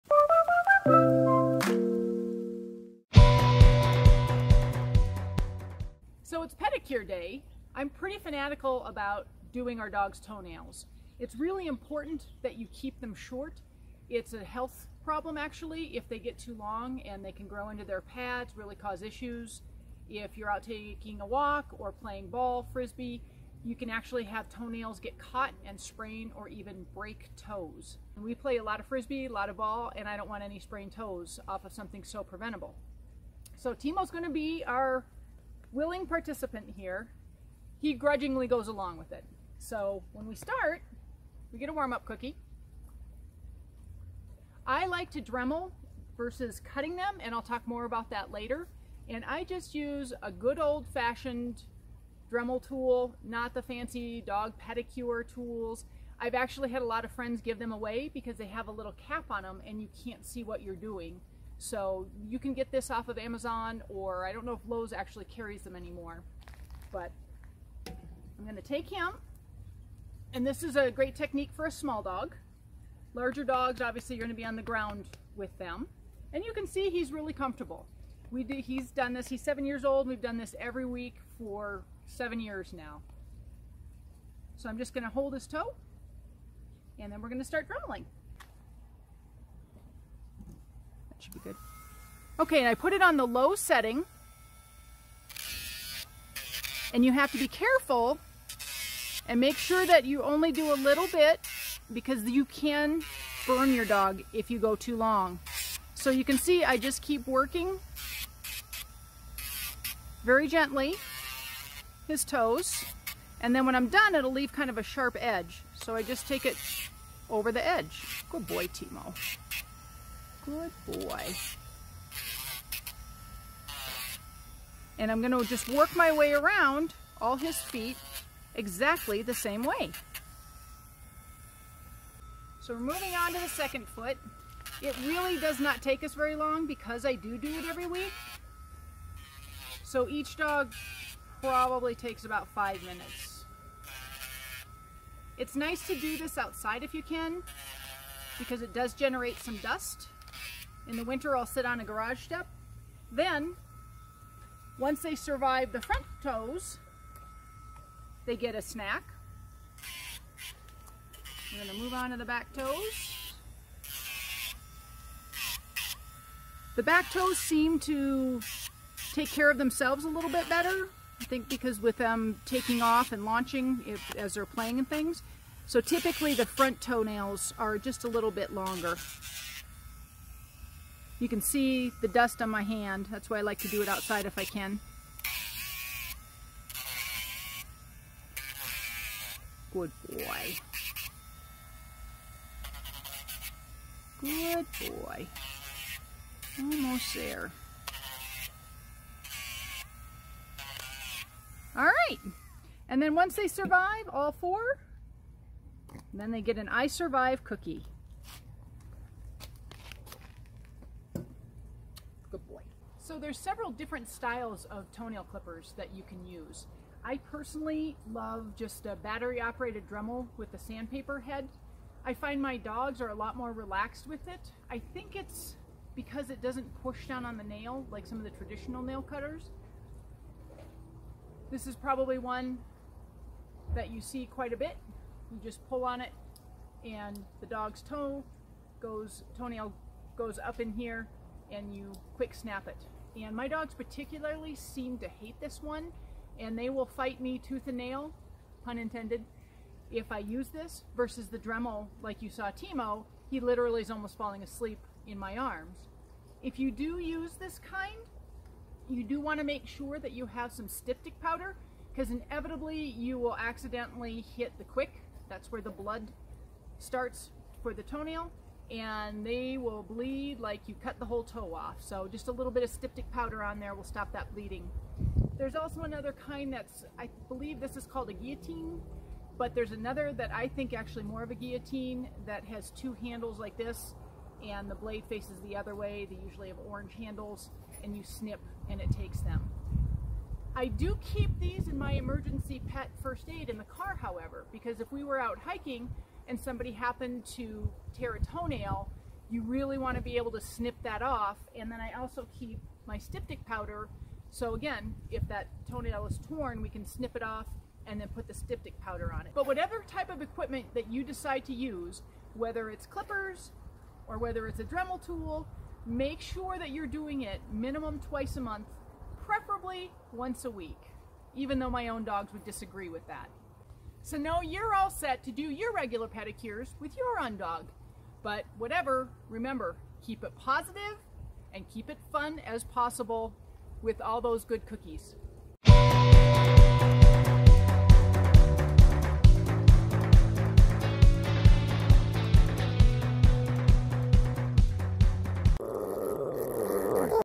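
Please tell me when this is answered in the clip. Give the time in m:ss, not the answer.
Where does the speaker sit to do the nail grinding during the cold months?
2:31.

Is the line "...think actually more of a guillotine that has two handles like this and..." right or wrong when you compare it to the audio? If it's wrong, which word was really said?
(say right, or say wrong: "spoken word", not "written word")
right.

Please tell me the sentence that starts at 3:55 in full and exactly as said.
You just pull on it and the dog's toe goes, toenail goes up in here and you quick snap it.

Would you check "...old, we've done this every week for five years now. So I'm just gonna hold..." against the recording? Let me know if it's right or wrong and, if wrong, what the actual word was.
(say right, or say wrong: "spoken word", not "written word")
wrong: "seven", not "five".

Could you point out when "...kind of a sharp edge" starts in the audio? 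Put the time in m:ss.
1:54.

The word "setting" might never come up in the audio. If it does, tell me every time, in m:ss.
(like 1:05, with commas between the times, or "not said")
1:33.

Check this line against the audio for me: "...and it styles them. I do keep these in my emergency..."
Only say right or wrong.
wrong.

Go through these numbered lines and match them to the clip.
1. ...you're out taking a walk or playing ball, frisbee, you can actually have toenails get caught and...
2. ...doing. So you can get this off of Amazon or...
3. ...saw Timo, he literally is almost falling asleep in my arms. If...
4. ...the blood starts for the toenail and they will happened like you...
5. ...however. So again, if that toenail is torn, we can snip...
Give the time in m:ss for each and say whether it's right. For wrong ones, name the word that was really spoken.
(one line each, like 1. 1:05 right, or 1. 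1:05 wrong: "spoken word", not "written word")
1. 0:20 right
2. 1:00 right
3. 4:12 right
4. 4:25 wrong: "bleed", not "happened"
5. 5:03 wrong: "powder", not "however".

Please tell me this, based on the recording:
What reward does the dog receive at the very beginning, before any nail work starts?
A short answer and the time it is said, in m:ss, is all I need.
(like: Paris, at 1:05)
warm-up cookie, at 0:41.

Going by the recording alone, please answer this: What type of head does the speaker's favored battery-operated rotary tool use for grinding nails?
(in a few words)
sandpaper head.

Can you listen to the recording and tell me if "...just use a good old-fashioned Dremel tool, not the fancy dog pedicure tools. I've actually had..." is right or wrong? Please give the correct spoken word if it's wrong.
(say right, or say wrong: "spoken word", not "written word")
right.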